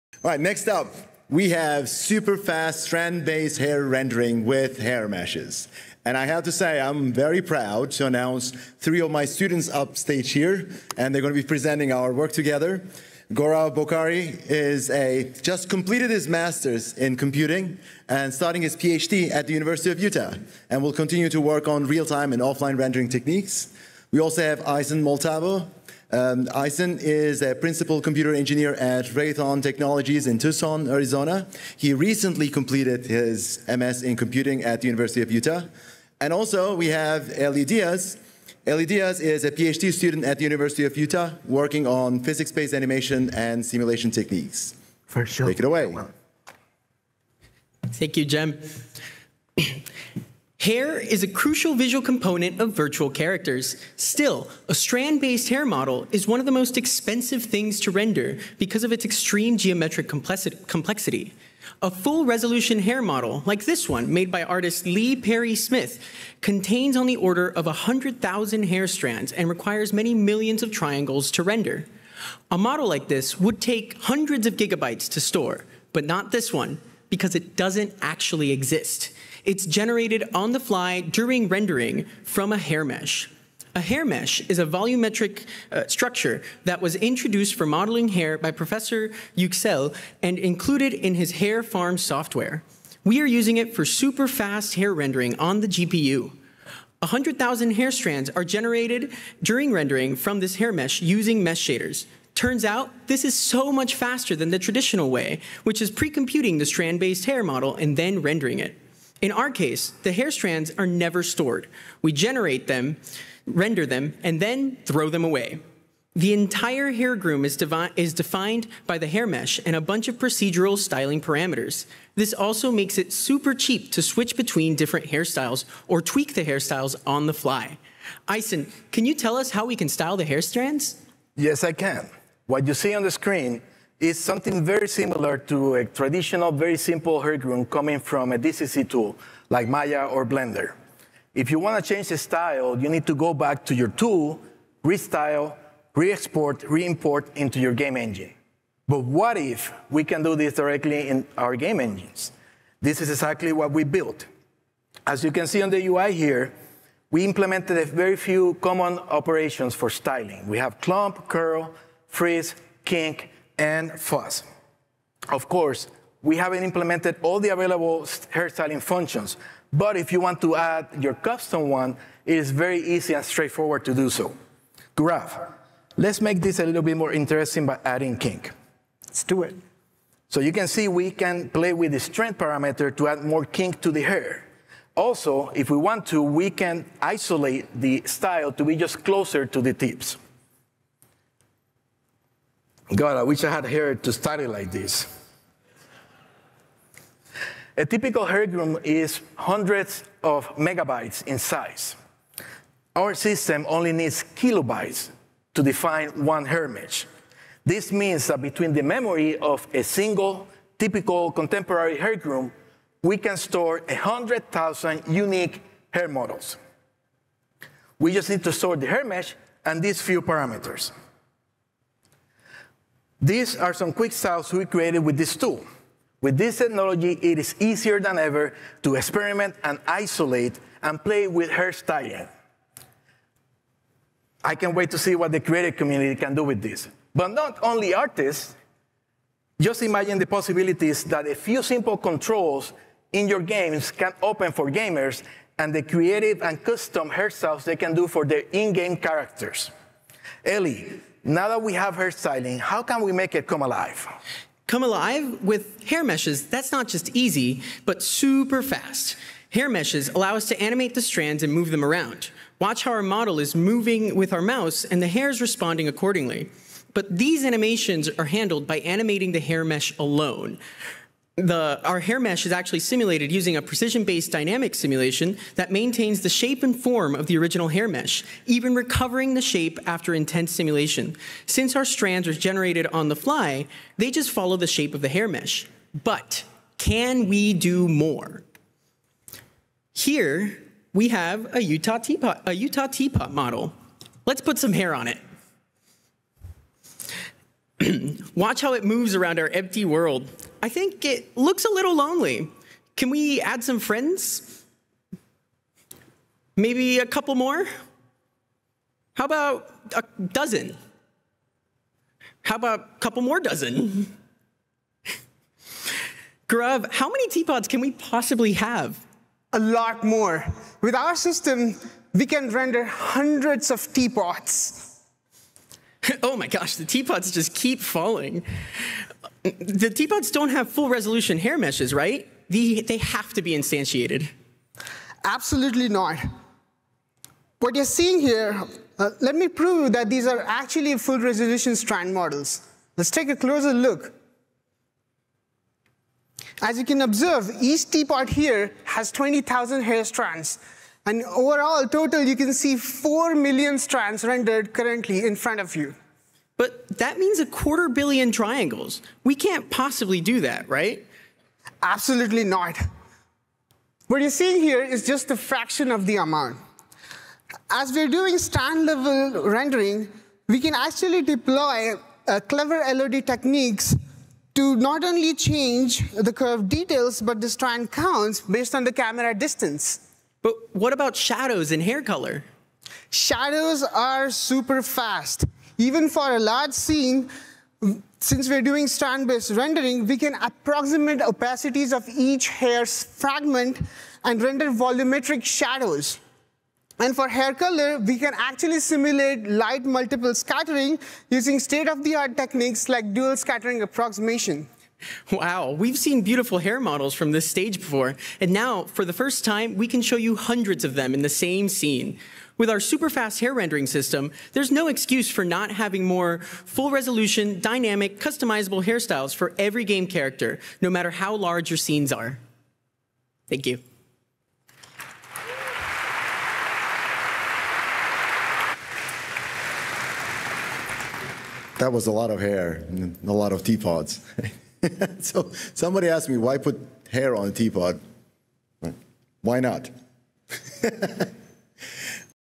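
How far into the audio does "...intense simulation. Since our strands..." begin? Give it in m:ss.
4:40.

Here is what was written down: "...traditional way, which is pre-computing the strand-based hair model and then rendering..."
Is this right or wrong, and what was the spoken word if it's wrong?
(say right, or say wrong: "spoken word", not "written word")
right.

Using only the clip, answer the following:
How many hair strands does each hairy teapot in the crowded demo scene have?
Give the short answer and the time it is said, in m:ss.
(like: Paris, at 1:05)
20,000, at 5:49.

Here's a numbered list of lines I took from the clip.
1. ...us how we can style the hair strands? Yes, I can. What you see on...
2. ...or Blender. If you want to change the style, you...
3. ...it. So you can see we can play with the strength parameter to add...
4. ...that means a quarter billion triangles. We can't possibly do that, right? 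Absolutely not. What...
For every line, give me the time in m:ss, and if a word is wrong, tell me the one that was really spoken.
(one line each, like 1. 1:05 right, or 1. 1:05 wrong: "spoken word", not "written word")
1. 2:09 right
2. 2:20 right
3. 2:59 right
4. 5:56 right.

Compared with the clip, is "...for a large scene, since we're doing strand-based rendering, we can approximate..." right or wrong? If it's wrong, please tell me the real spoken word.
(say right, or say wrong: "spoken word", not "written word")
right.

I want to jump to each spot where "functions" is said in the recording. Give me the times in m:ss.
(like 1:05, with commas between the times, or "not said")
2:48.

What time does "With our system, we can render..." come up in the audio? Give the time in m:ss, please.
5:20.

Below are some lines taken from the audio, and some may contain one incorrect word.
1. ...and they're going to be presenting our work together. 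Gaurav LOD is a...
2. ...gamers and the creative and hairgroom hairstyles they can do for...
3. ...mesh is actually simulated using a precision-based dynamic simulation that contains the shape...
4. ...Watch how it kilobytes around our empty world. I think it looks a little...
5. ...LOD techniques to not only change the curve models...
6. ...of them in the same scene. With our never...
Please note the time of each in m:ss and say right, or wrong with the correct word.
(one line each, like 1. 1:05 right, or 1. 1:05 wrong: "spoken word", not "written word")
1. 0:10 wrong: "Bhokare", not "LOD"
2. 4:04 wrong: "custom", not "hairgroom"
3. 4:32 wrong: "maintains", not "contains"
4. 4:58 wrong: "moves", not "kilobytes"
5. 6:12 wrong: "details", not "models"
6. 6:50 wrong: "super", not "never".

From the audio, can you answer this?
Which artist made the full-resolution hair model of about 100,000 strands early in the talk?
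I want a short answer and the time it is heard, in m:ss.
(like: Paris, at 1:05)
Lee Perry Smith, at 1:04.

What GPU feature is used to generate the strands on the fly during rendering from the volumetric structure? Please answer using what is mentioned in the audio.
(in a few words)
mesh shaders.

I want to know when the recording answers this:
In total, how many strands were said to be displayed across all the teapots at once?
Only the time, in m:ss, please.
5:52.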